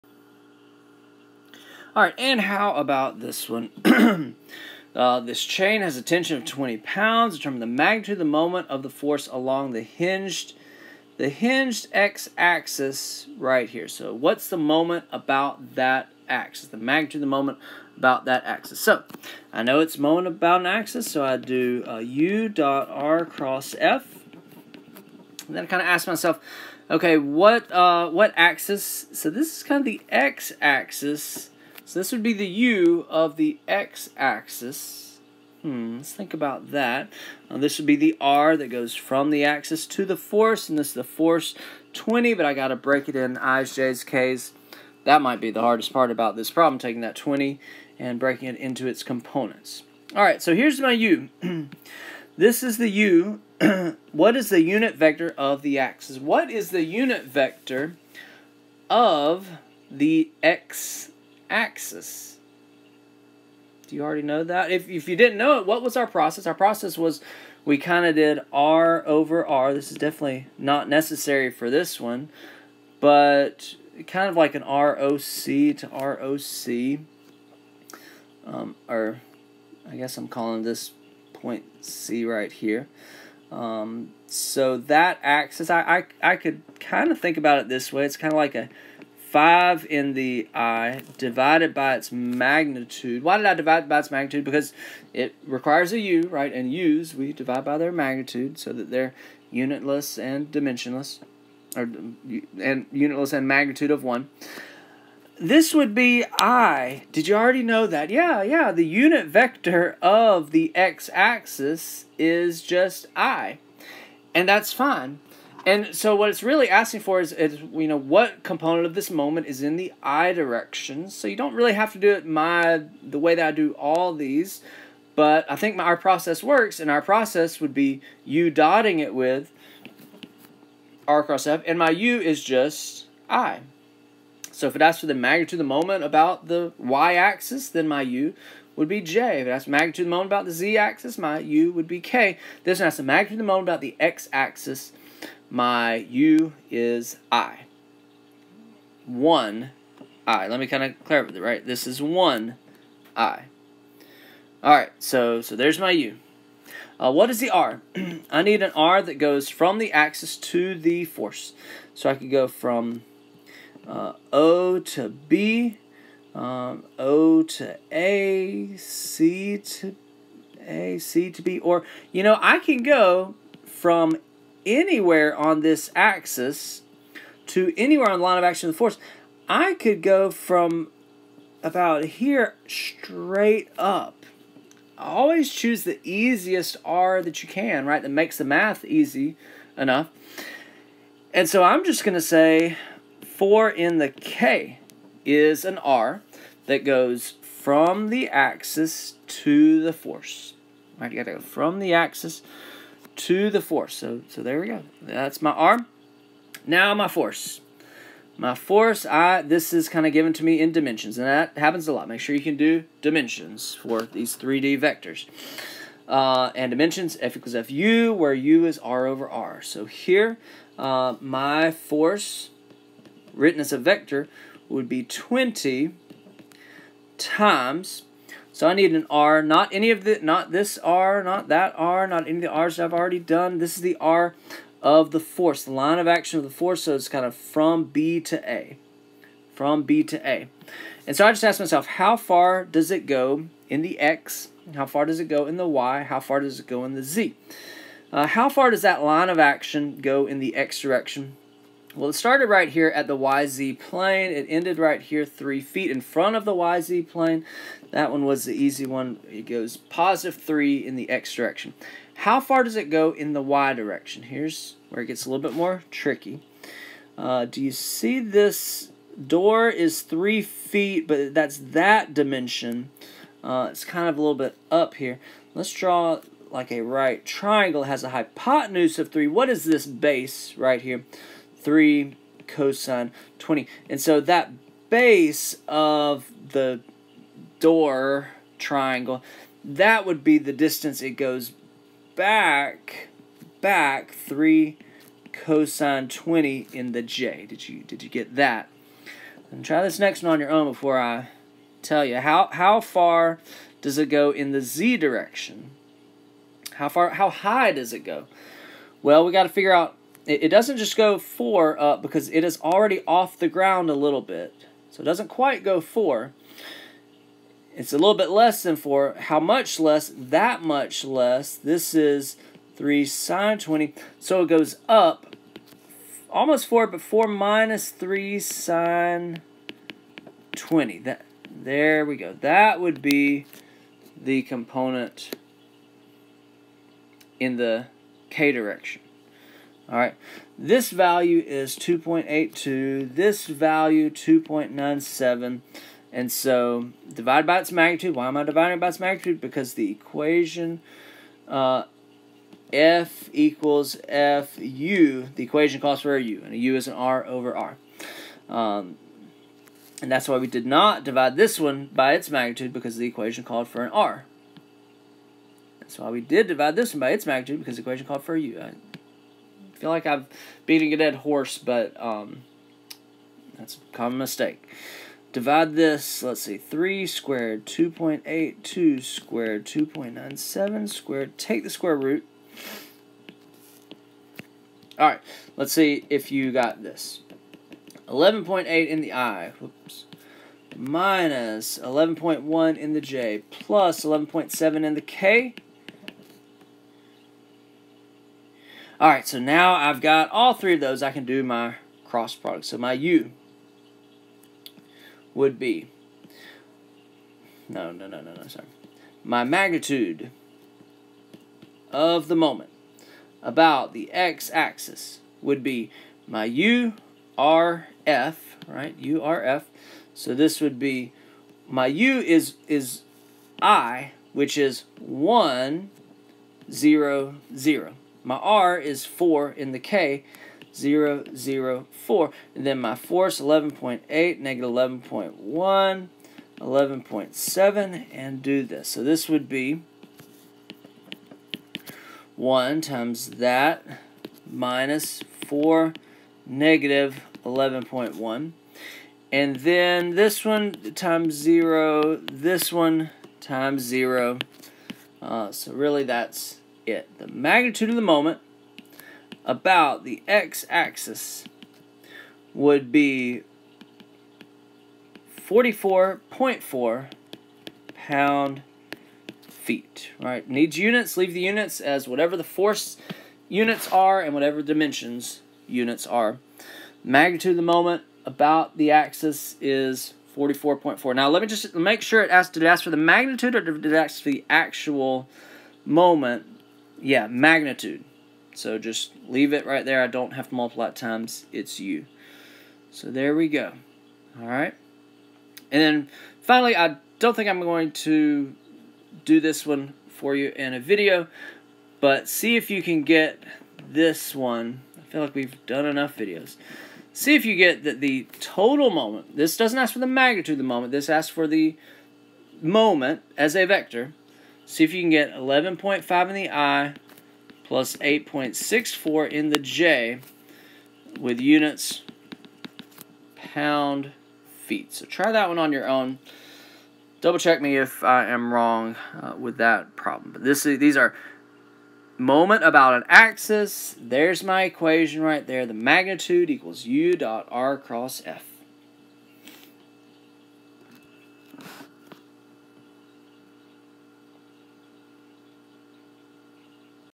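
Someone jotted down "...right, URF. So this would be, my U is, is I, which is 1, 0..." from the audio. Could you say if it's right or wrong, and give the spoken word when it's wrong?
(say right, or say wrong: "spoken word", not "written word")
right.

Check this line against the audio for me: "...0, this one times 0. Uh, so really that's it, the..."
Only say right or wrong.
right.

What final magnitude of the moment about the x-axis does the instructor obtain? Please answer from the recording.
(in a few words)
44.4 pound feet.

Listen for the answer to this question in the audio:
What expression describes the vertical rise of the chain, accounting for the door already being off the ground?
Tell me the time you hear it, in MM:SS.
05:27.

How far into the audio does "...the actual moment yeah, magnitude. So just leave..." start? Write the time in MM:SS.
08:04.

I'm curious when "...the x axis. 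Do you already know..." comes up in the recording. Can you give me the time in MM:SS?
00:59.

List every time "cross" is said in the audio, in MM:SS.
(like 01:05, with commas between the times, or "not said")
00:23, 02:11, 06:42, 08:57.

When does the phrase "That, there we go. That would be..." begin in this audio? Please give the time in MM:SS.
05:30.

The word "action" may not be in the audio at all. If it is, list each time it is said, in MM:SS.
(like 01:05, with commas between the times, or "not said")
02:58, 03:56, 04:09.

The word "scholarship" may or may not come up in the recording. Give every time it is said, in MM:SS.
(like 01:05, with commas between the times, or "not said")
not said.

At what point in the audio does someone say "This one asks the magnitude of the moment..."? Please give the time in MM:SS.
02:22.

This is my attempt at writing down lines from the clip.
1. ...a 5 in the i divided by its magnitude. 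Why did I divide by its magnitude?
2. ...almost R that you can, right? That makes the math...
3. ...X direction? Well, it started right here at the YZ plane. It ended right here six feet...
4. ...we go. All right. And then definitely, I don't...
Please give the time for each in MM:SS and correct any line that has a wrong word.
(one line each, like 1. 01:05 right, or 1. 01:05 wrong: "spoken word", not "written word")
1. 01:28 right
2. 03:06 wrong: "easiest", not "almost"
3. 04:10 wrong: "three", not "six"
4. 08:13 wrong: "finally", not "definitely".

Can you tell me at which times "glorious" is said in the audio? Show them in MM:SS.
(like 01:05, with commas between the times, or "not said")
not said.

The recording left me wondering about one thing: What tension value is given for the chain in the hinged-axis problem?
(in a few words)
20 pounds.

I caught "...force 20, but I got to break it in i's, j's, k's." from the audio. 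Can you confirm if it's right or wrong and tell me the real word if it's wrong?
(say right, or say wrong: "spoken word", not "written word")
right.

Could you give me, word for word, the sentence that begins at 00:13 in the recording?
So what's the moment about that axis?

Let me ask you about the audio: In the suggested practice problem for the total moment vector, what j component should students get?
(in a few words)
8.64.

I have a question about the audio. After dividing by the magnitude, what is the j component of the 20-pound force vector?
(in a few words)
-11.1.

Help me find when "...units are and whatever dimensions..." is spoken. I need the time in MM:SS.
07:53.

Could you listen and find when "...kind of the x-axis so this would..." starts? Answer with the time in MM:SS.
00:29.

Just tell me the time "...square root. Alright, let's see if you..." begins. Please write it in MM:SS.
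06:21.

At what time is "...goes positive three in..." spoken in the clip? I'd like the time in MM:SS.
04:19.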